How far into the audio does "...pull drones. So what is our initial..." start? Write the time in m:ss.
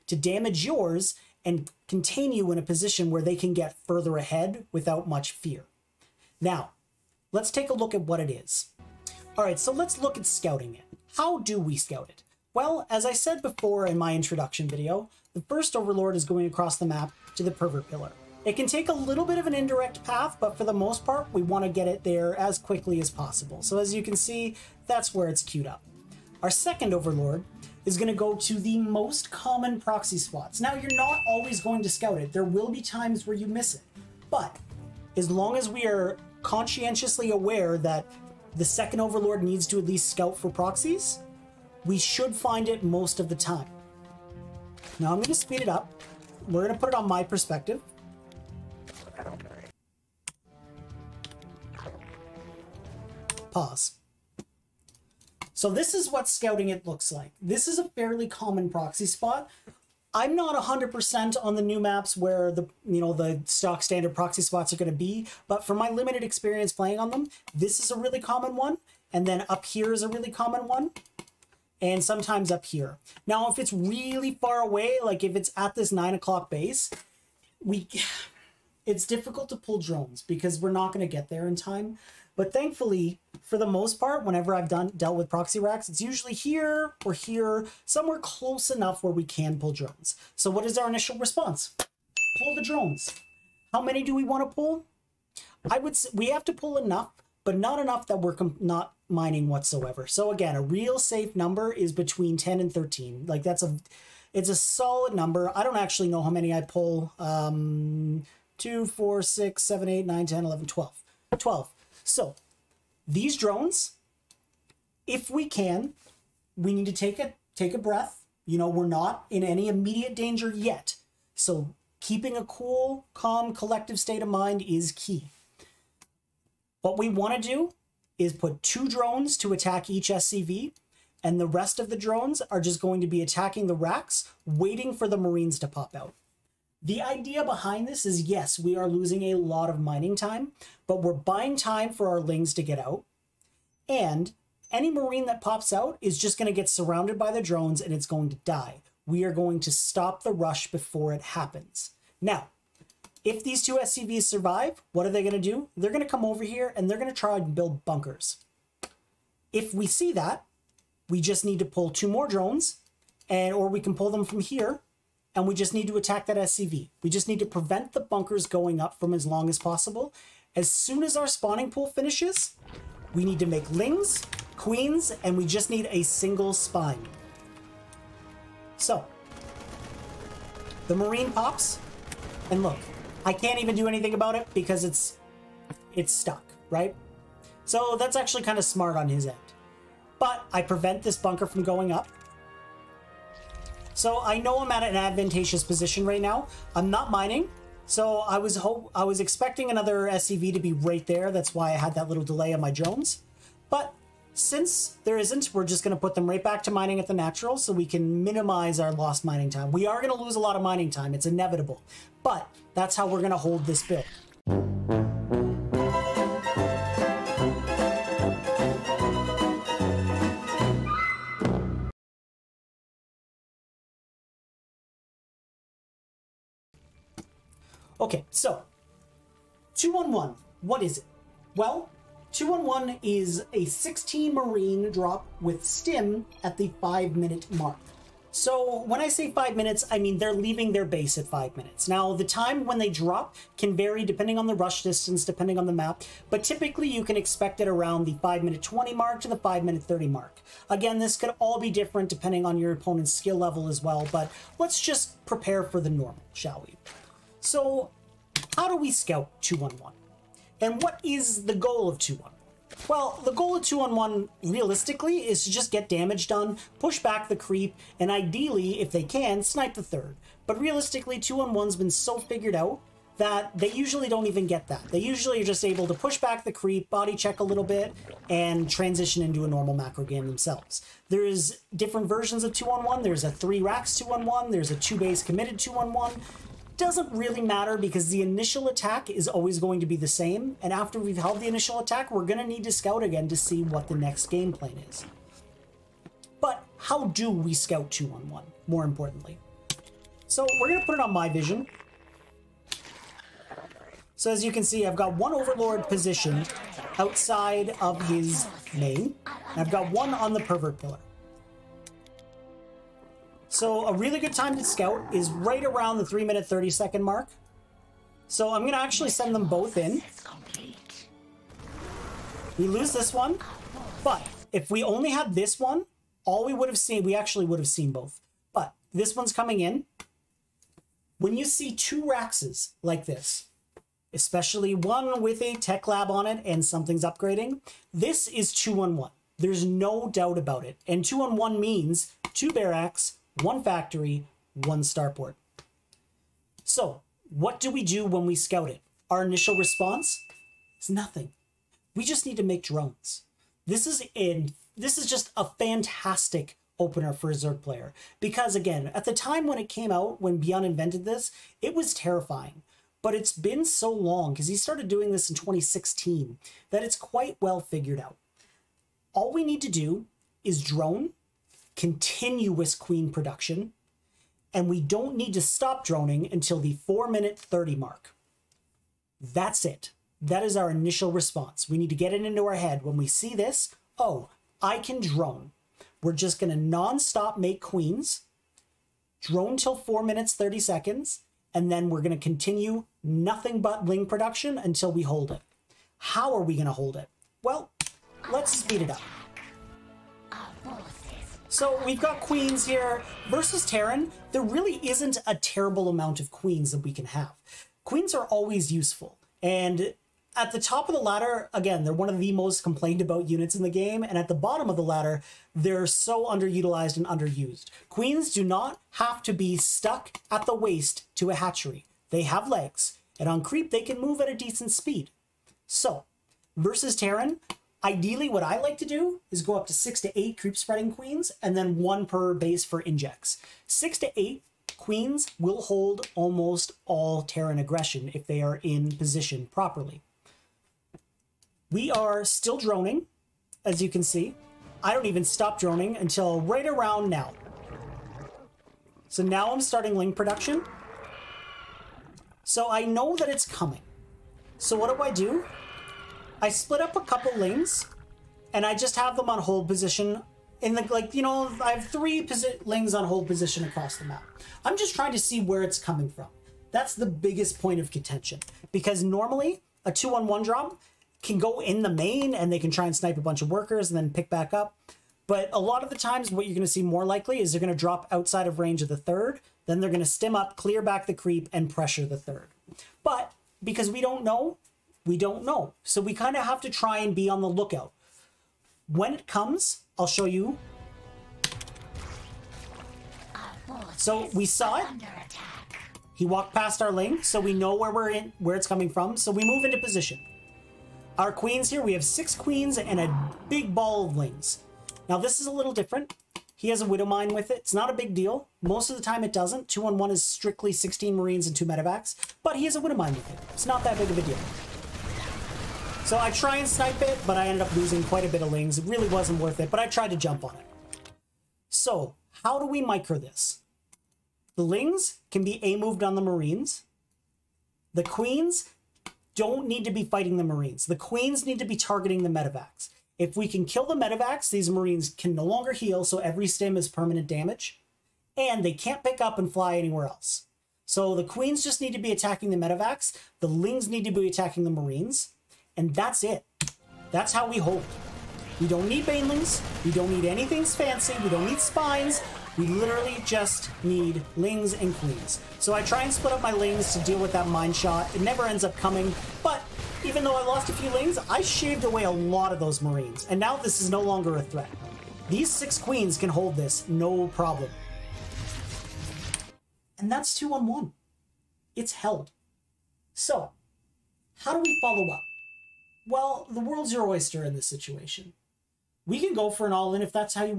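1:29.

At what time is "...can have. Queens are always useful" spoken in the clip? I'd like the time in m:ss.
6:46.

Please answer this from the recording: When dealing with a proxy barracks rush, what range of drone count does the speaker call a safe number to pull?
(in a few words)
10 to 13.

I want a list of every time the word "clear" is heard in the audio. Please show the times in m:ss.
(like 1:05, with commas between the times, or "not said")
8:00.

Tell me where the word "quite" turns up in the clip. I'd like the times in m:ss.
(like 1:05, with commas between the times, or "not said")
6:06, 8:38.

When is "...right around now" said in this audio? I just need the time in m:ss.
7:26.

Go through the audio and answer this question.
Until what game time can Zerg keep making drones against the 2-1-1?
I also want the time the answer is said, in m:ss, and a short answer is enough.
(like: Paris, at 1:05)
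4:30, at 6:16.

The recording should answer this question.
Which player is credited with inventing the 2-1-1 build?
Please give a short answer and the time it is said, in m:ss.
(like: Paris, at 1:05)
ByuN, at 6:00.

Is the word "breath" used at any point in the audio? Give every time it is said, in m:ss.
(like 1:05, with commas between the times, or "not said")
1:57.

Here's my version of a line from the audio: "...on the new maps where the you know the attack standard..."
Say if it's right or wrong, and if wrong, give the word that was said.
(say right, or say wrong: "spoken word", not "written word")
wrong: "stock", not "attack".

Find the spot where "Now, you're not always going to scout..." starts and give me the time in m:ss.
0:30.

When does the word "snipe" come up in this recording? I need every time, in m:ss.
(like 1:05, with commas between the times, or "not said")
4:29, 7:52, 8:36.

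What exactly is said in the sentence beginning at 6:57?
Queens do not have to be stuck at the waist to a hatchery.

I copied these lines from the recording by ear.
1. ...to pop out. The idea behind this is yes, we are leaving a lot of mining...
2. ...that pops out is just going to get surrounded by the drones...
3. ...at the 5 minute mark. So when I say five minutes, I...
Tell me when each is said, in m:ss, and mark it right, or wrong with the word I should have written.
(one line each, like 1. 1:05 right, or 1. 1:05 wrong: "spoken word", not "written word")
1. 2:15 wrong: "losing", not "leaving"
2. 2:25 right
3. 3:56 right.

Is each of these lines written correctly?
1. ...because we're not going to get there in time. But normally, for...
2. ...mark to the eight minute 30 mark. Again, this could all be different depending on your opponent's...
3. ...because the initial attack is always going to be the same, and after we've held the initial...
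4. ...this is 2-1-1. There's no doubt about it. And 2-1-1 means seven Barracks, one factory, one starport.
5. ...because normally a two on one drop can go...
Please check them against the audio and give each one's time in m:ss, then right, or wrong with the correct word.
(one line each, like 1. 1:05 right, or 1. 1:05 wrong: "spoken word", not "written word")
1. 1:20 wrong: "thankfully", not "normally"
2. 4:08 wrong: "five", not "eight"
3. 4:47 right
4. 5:37 wrong: "two", not "seven"
5. 7:48 right.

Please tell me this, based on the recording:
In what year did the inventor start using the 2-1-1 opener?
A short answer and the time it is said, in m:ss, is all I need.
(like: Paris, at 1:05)
2016, at 6:05.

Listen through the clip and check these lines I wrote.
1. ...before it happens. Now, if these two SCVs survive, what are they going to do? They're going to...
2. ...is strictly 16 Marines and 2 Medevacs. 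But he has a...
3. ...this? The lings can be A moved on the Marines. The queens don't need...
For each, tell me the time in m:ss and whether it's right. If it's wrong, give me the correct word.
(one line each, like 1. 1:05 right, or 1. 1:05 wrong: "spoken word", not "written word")
1. 2:30 right
2. 8:30 right
3. 8:43 right.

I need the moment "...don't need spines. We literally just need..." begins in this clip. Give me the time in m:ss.
9:11.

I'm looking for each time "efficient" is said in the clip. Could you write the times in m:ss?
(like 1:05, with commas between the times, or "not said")
not said.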